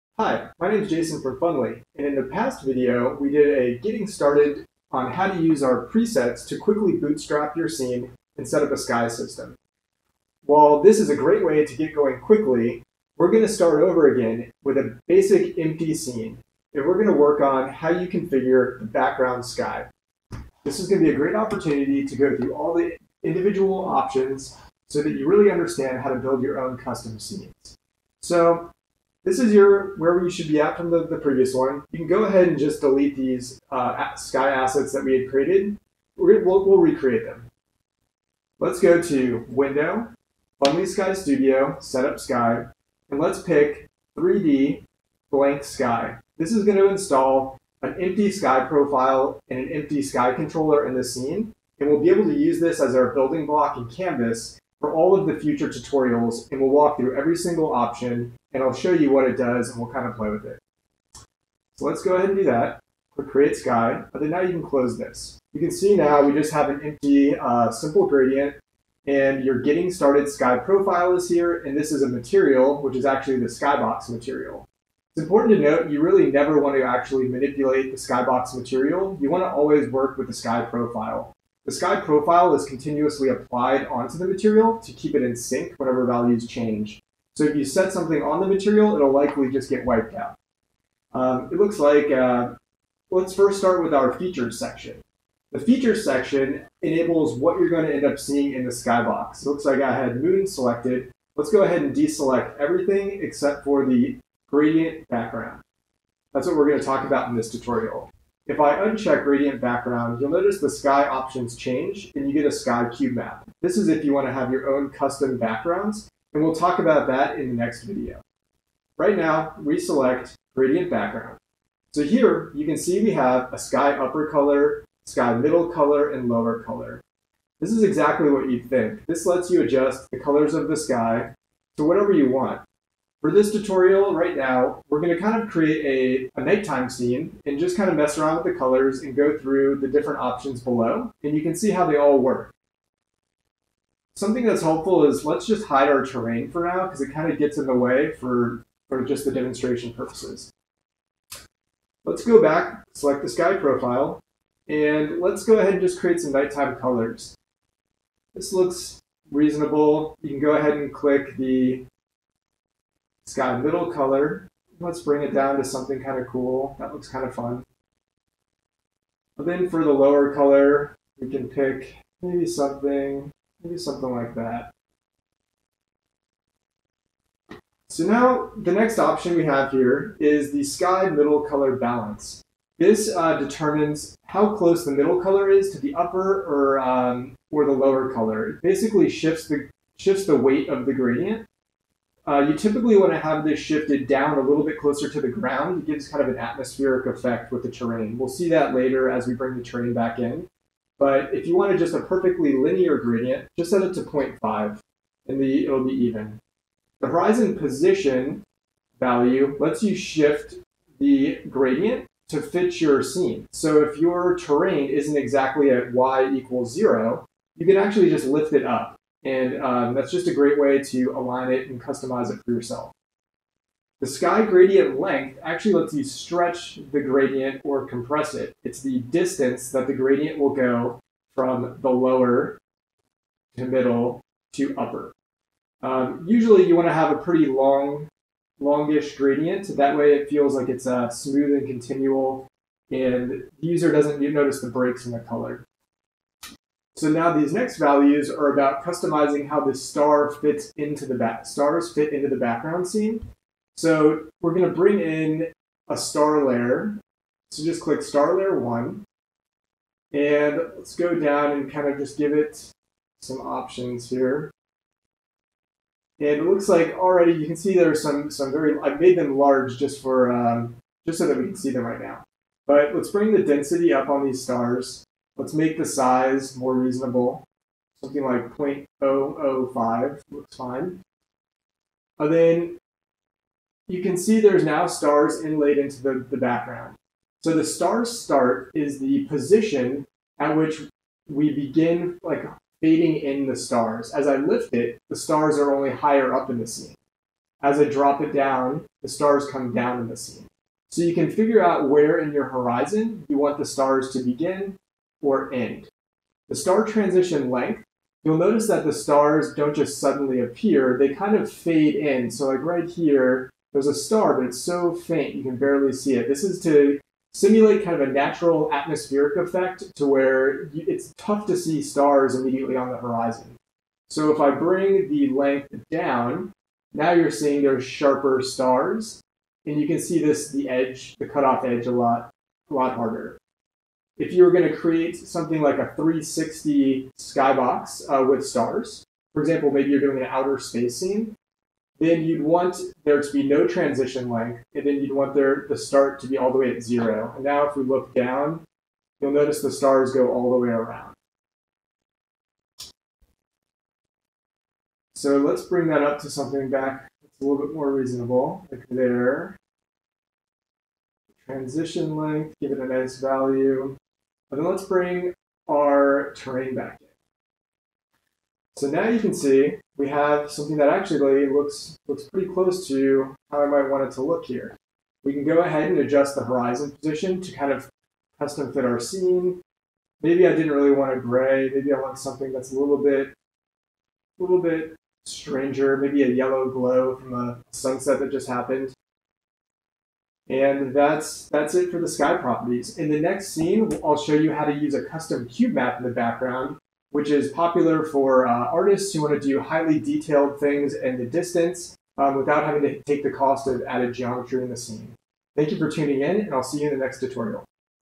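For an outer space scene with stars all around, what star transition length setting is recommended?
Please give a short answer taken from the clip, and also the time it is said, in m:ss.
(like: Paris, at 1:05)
no transition length, at 5:43.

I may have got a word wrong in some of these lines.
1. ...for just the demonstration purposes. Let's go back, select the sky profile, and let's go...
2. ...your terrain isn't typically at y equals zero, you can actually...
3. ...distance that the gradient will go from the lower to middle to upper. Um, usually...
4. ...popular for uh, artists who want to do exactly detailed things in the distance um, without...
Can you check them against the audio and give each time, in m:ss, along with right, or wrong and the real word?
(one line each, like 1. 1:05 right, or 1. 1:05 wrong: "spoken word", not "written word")
1. 2:28 right
2. 3:33 wrong: "exactly", not "typically"
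3. 3:48 right
4. 6:37 wrong: "highly", not "exactly".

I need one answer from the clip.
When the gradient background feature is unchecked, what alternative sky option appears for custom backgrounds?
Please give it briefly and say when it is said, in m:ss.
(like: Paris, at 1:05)
sky cube map, at 1:52.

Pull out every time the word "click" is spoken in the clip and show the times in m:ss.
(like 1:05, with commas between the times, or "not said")
1:03, 2:40, 4:17.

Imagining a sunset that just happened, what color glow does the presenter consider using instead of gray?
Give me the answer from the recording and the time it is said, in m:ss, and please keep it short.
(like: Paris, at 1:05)
yellow, at 6:26.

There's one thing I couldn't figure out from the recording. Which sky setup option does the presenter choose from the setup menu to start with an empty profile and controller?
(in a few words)
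3D Blank Sky.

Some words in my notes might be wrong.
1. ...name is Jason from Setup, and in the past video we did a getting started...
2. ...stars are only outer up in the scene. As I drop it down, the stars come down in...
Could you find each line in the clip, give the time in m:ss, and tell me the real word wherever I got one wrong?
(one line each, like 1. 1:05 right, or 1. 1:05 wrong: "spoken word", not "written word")
1. 0:00 wrong: "Funly", not "Setup"
2. 4:55 wrong: "higher", not "outer".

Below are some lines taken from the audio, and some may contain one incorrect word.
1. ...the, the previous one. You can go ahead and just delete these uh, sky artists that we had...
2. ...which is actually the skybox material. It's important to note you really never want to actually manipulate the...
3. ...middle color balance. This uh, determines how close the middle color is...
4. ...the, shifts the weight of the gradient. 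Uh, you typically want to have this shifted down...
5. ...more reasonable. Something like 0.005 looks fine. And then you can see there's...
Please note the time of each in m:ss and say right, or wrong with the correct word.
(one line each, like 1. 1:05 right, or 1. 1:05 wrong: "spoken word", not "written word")
1. 0:30 wrong: "assets", not "artists"
2. 1:12 right
3. 3:01 right
4. 3:09 right
5. 4:36 right.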